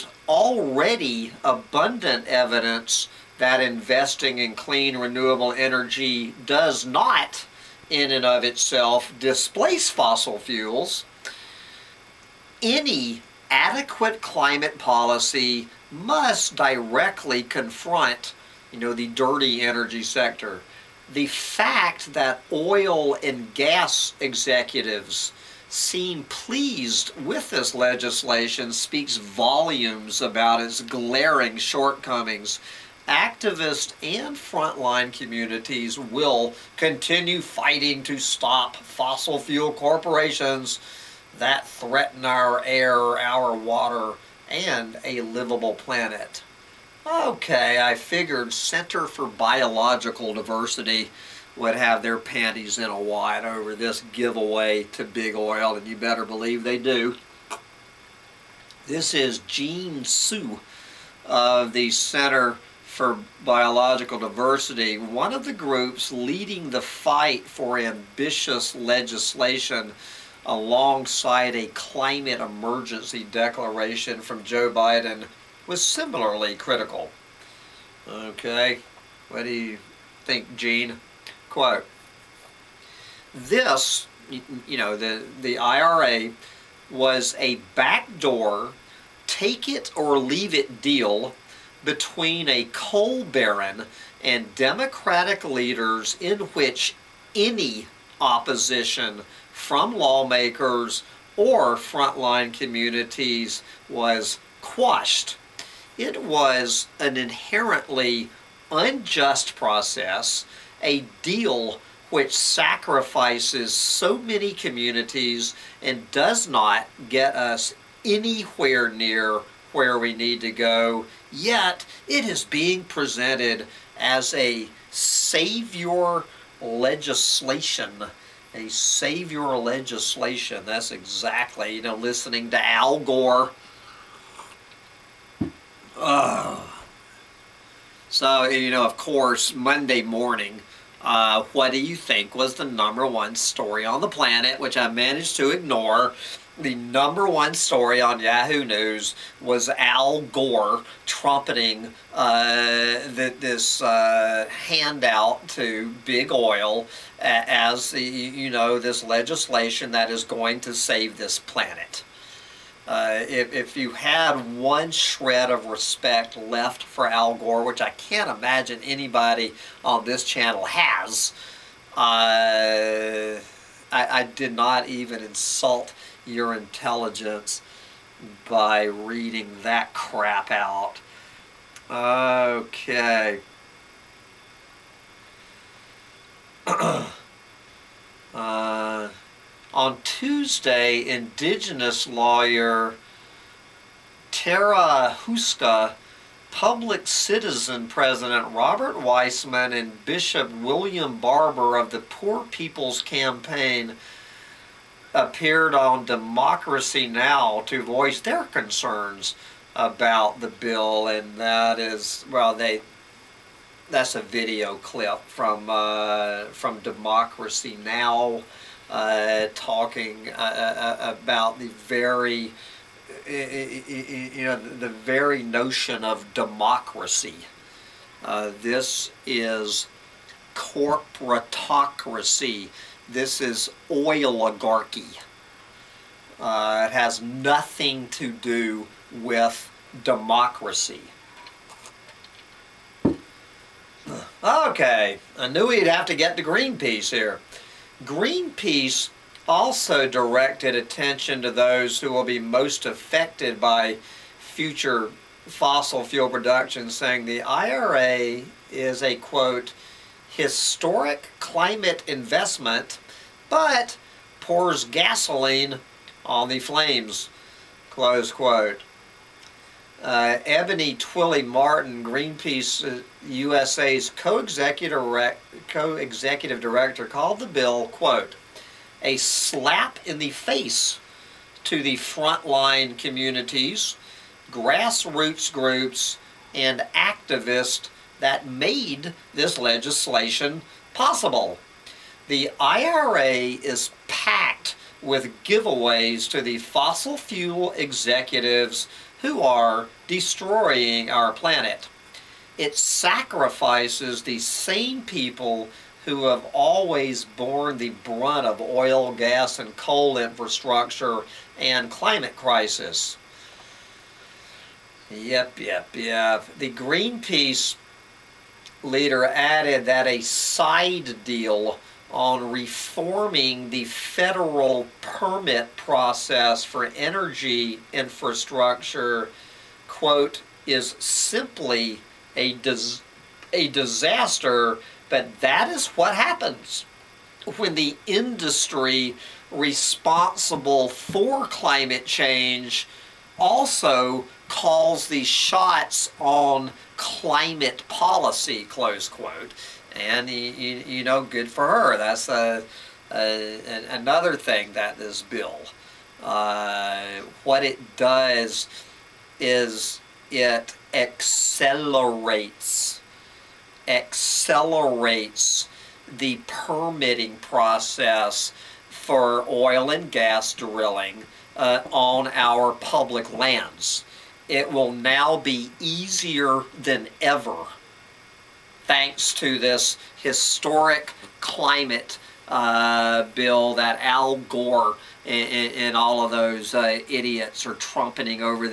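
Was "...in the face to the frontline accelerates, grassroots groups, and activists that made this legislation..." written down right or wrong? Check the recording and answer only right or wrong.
wrong.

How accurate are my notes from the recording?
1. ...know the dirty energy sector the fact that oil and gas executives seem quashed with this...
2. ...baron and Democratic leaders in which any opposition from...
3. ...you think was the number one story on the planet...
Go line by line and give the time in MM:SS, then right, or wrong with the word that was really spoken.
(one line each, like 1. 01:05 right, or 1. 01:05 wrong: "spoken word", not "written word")
1. 00:18 wrong: "pleased", not "quashed"
2. 01:33 right
3. 02:21 right.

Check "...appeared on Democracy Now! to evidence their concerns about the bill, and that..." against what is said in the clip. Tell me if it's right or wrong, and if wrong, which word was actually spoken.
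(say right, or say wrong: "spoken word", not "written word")
wrong: "voice", not "evidence".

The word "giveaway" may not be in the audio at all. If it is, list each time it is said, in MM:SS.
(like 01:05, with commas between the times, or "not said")
00:54, 04:55.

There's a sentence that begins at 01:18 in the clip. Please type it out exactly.
Okay, what do you think, Jean?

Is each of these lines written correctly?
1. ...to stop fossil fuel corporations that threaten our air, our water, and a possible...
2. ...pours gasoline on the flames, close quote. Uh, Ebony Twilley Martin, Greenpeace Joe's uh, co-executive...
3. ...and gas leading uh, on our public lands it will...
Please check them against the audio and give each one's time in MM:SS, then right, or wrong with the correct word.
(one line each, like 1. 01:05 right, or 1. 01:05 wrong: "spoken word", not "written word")
1. 00:38 wrong: "livable", not "possible"
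2. 04:24 wrong: "USA", not "Joe"
3. 06:09 wrong: "drilling", not "leading".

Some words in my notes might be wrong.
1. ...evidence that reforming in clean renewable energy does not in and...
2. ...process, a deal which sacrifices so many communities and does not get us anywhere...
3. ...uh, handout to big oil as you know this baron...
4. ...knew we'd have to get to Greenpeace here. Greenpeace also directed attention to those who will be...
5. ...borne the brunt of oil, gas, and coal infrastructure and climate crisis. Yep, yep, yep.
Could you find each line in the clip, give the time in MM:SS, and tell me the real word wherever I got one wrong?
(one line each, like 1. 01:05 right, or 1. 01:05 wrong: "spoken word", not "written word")
1. 00:02 wrong: "investing", not "reforming"
2. 01:49 right
3. 02:33 wrong: "legislation", not "baron"
4. 04:05 right
5. 05:07 right.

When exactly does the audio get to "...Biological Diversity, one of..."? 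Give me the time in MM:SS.
01:03.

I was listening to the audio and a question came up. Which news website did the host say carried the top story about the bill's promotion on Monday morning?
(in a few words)
Yahoo News.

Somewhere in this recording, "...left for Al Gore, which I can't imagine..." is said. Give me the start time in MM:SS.
02:46.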